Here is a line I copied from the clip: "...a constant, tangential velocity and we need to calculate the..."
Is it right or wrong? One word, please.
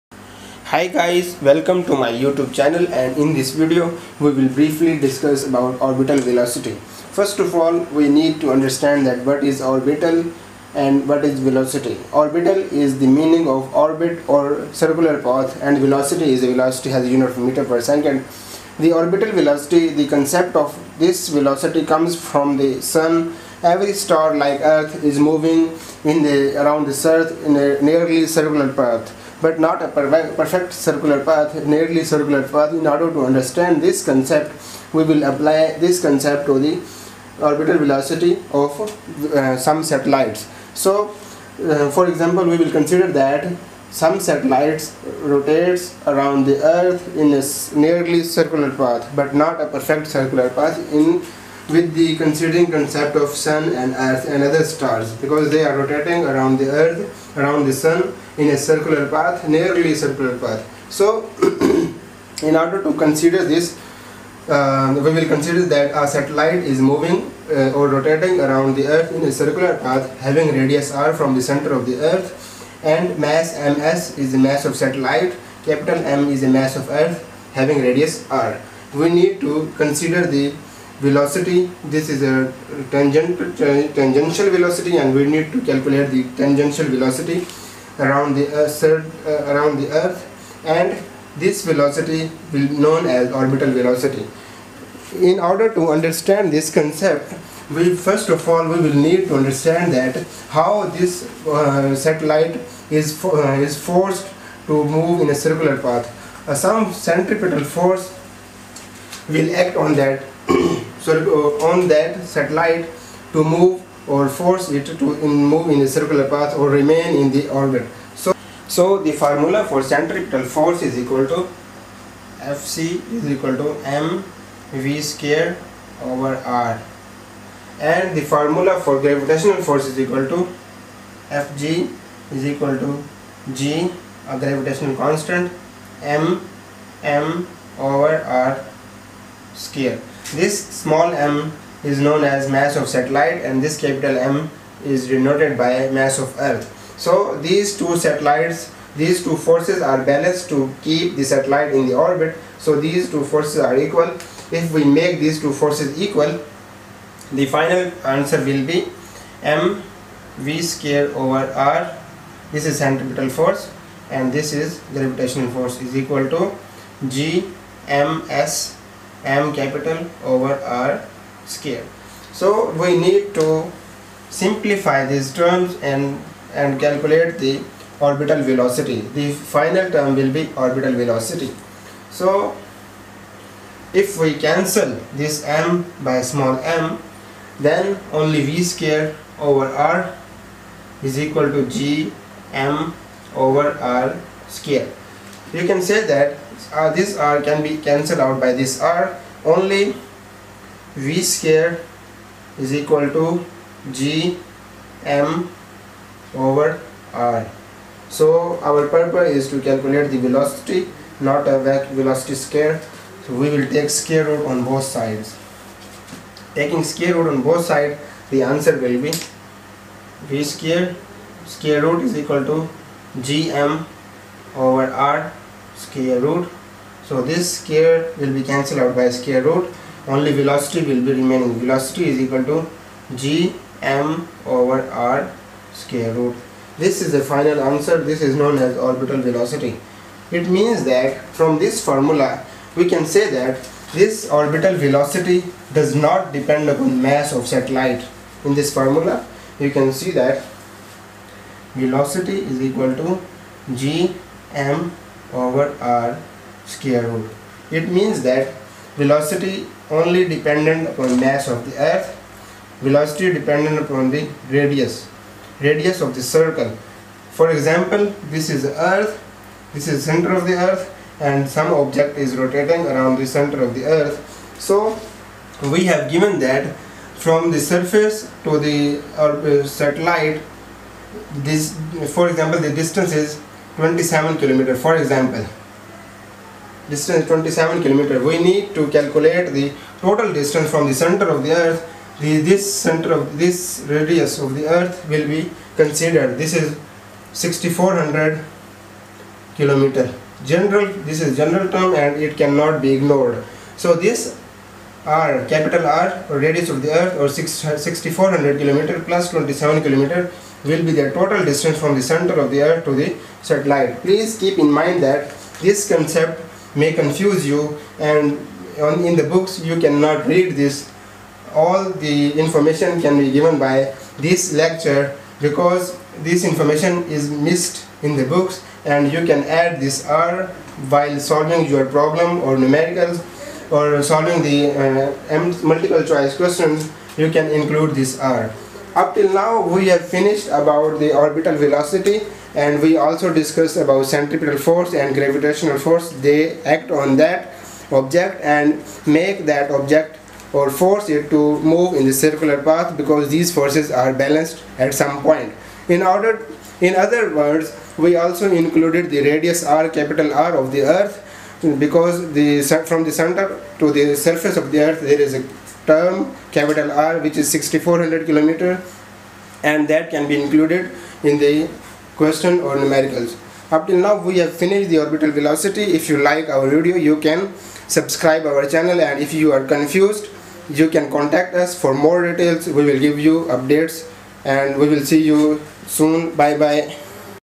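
wrong.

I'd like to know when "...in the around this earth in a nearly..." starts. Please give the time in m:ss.
0:26.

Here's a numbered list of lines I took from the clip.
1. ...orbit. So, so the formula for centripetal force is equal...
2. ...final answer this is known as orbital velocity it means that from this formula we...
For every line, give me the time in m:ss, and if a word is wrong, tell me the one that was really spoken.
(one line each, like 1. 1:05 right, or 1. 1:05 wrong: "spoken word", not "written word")
1. 1:57 right
2. 3:57 right.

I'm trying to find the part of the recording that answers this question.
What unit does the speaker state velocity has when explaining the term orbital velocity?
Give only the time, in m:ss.
0:17.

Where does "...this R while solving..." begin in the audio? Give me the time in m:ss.
5:29.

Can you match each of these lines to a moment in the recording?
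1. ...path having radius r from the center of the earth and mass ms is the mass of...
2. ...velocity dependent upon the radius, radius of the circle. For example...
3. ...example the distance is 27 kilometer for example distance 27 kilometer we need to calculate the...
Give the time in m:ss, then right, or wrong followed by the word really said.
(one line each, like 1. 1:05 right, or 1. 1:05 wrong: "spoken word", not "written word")
1. 1:09 right
2. 4:22 right
3. 4:42 right.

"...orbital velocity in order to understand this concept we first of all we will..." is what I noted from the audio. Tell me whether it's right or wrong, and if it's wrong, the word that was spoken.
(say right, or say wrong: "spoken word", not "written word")
right.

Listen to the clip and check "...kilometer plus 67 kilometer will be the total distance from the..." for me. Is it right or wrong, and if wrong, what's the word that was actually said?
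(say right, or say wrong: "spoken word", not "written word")
wrong: "27", not "67".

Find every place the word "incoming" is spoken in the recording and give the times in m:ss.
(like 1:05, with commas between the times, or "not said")
not said.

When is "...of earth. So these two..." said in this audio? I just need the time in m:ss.
2:26.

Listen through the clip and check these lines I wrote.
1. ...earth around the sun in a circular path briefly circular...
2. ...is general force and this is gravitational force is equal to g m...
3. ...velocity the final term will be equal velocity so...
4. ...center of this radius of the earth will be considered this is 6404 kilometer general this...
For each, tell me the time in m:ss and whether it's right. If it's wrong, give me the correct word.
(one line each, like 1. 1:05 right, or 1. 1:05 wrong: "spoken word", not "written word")
1. 0:56 wrong: "nearly", not "briefly"
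2. 2:42 wrong: "centripetal", not "general"
3. 2:58 wrong: "orbital", not "equal"
4. 4:52 wrong: "6400", not "6404".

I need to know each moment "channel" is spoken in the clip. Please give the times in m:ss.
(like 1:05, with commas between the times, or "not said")
0:02, 6:18.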